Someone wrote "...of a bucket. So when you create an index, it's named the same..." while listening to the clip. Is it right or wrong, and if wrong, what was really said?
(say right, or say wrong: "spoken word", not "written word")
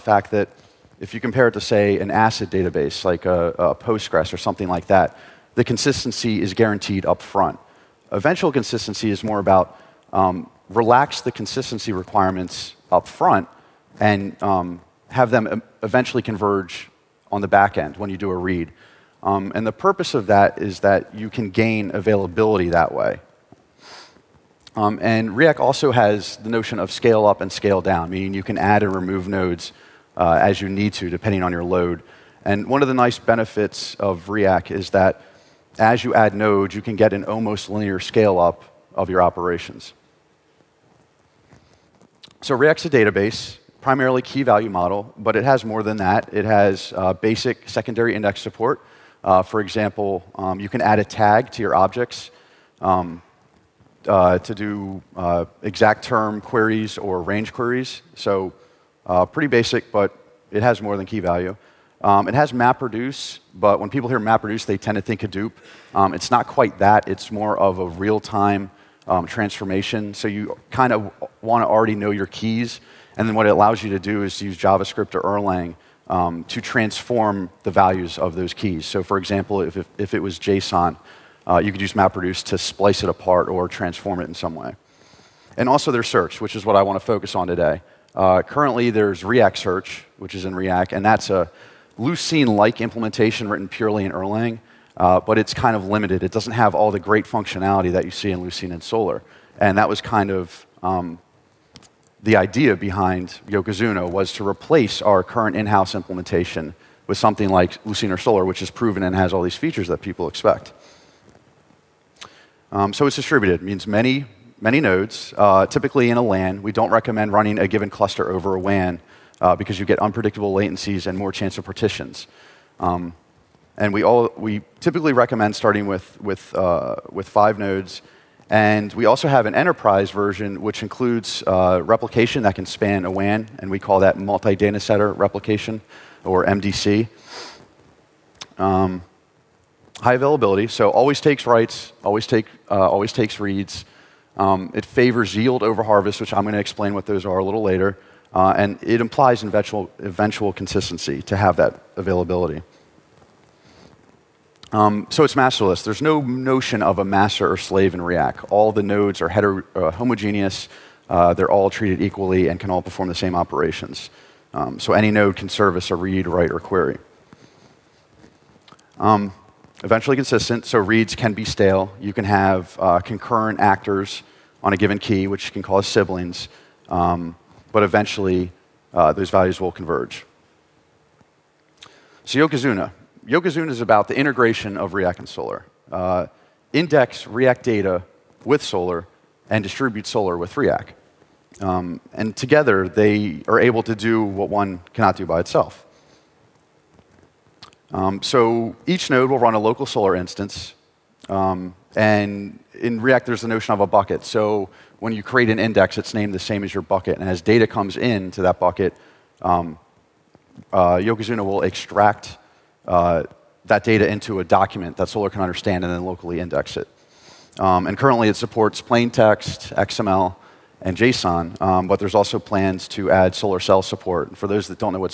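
right.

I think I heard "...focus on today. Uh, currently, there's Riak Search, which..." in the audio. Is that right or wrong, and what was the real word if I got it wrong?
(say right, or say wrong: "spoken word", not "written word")
right.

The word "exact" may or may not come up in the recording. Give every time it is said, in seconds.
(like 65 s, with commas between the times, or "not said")
55 s.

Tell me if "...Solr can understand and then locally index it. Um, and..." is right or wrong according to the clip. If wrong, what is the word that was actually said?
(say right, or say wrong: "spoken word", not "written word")
right.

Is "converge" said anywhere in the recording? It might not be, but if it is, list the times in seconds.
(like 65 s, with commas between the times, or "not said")
16 s, 179 s.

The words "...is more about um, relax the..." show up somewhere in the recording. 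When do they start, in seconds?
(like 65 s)
9 s.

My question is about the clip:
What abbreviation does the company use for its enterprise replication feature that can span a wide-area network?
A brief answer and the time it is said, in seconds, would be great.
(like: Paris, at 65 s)
MDC, at 136 s.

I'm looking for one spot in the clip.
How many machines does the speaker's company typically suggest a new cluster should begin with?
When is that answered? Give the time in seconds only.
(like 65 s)
127 s.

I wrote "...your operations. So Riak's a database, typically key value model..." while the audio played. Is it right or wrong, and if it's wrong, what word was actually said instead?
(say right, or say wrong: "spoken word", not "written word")
wrong: "primarily", not "typically".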